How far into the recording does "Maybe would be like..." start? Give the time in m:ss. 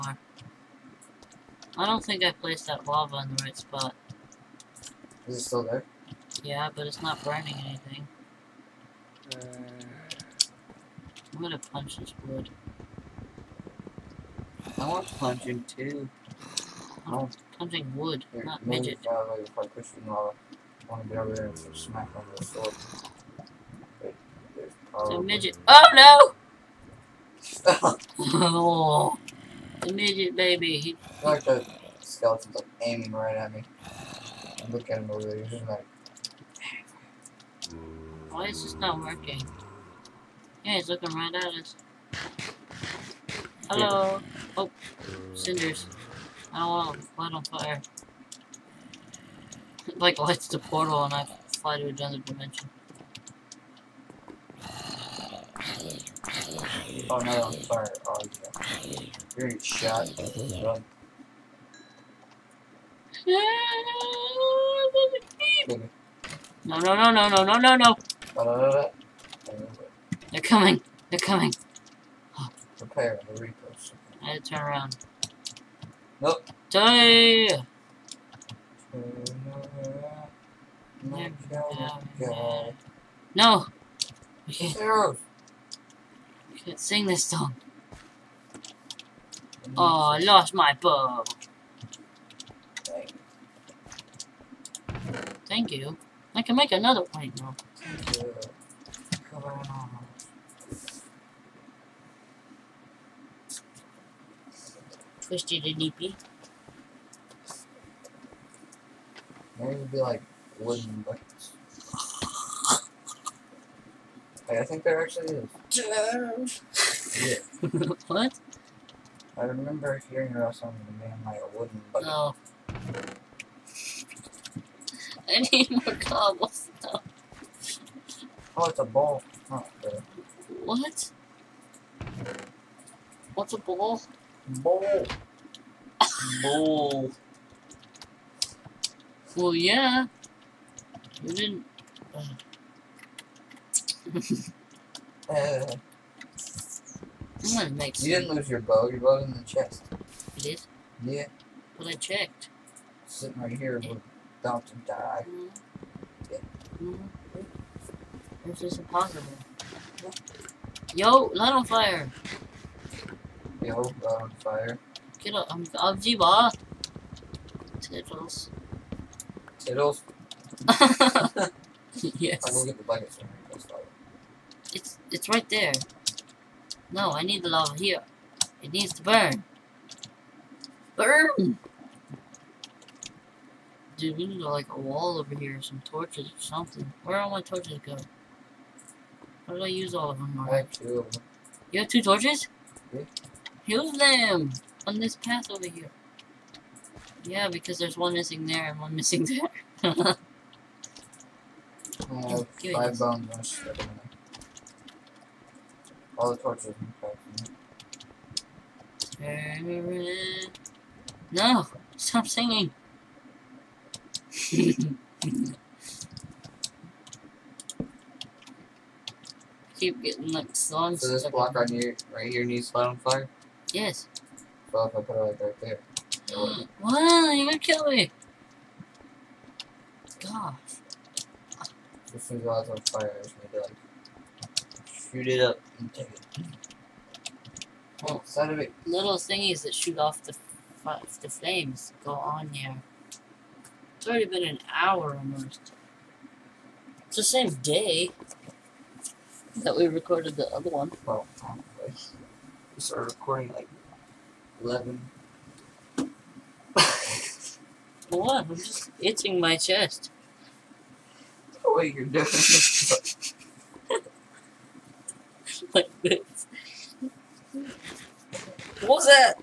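1:49.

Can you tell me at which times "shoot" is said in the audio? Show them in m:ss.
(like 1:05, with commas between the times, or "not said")
3:55, 3:59.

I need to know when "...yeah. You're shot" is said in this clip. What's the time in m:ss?
0:58.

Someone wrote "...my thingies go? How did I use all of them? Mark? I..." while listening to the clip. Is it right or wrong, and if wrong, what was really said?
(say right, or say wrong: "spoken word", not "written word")
wrong: "torches", not "thingies".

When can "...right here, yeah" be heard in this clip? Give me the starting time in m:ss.
2:33.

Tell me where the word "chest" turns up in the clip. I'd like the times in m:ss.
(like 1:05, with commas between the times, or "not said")
2:29, 4:19.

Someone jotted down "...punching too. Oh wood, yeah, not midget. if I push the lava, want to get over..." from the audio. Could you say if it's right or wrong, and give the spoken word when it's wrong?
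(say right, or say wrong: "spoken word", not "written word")
right.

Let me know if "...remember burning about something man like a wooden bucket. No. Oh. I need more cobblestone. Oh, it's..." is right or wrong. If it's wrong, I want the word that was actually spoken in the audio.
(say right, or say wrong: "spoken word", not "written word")
wrong: "hearing", not "burning".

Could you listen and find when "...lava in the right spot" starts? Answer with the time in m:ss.
0:02.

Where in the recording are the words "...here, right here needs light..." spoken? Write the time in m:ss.
3:41.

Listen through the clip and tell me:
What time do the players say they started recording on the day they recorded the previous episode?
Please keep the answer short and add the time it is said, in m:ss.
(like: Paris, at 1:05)
11, at 4:14.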